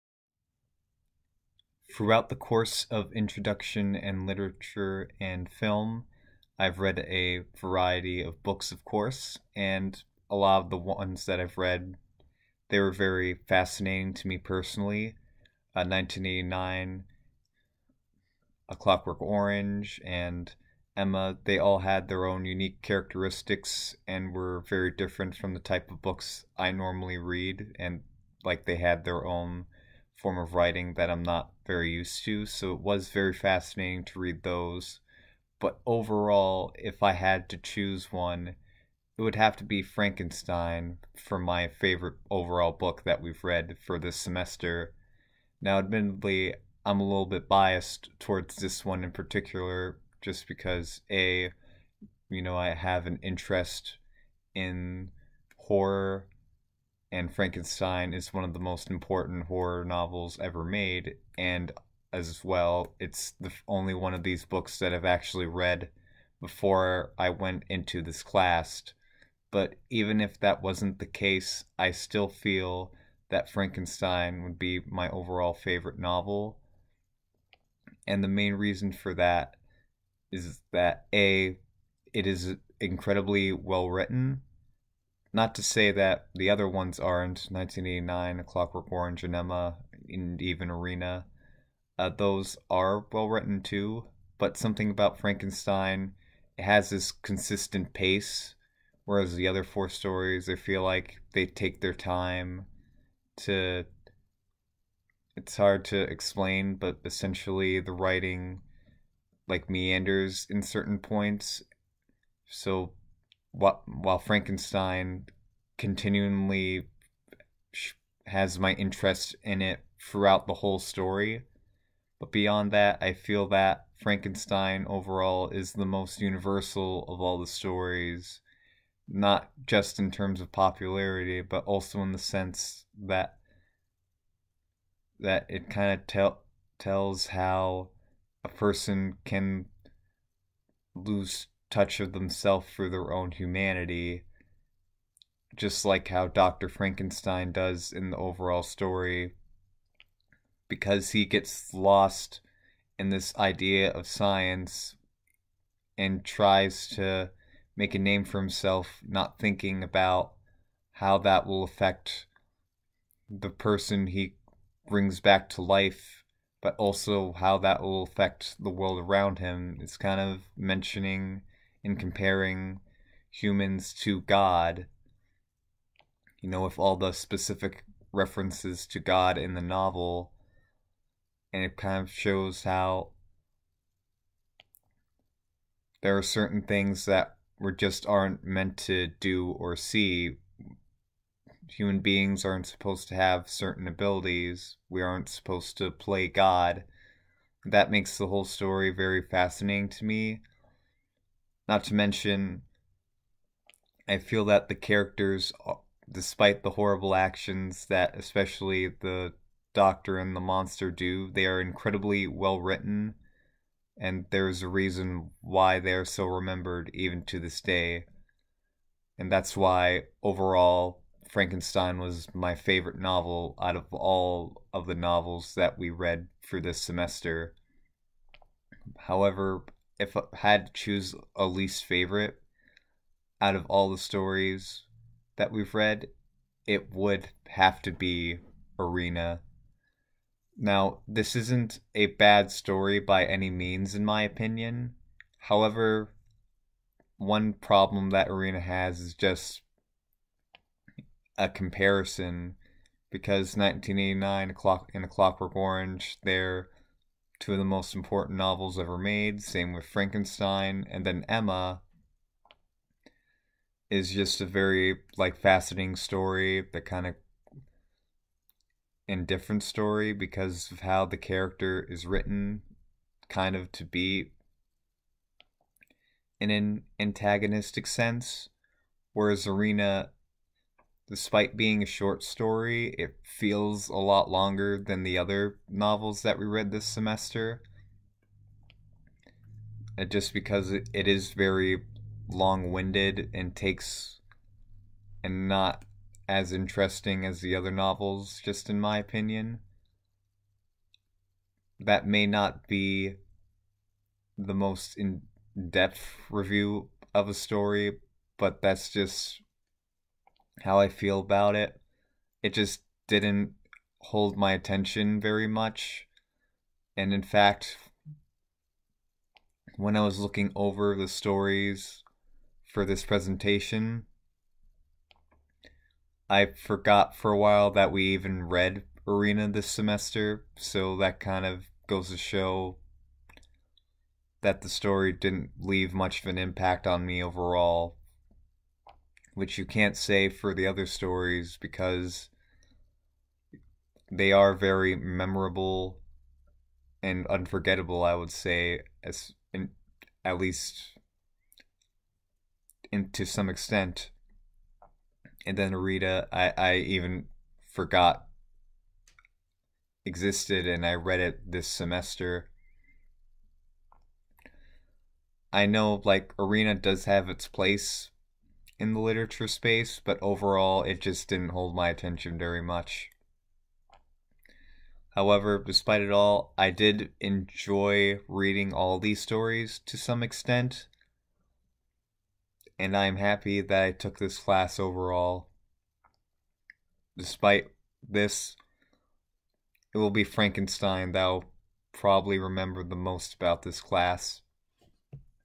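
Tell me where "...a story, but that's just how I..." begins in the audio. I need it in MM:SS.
05:07.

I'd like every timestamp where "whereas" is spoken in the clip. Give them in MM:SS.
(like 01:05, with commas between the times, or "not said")
01:39, 04:39.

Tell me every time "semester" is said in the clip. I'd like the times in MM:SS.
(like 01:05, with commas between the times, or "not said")
00:44, 03:46, 04:46, 05:29, 06:01.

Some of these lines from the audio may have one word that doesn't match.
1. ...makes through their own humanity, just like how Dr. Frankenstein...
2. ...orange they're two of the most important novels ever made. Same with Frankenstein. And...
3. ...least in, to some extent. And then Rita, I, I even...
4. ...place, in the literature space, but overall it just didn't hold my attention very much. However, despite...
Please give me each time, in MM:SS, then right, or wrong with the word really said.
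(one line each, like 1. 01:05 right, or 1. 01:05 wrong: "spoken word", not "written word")
1. 02:22 wrong: "themselves", not "makes"
2. 04:15 right
3. 05:50 right
4. 06:07 right.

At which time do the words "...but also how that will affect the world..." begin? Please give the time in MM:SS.
02:46.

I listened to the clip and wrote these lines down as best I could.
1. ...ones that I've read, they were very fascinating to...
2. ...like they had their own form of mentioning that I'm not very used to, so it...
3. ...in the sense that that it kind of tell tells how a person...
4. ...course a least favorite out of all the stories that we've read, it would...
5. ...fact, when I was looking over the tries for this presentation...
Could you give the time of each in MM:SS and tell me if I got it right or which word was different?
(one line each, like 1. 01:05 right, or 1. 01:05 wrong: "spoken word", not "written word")
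1. 00:10 right
2. 00:28 wrong: "writing", not "mentioning"
3. 02:12 right
4. 03:50 wrong: "choose", not "course"
5. 05:17 wrong: "stories", not "tries".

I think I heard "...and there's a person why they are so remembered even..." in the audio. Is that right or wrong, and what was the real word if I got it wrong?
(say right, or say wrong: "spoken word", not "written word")
wrong: "reason", not "person".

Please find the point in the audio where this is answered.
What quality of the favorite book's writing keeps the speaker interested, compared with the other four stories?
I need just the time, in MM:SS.
01:37.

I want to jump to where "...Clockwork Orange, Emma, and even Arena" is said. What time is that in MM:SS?
01:28.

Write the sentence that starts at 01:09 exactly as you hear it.
But even if that wasn't the case, I still feel that Frankenstein would be my overall favorite novel.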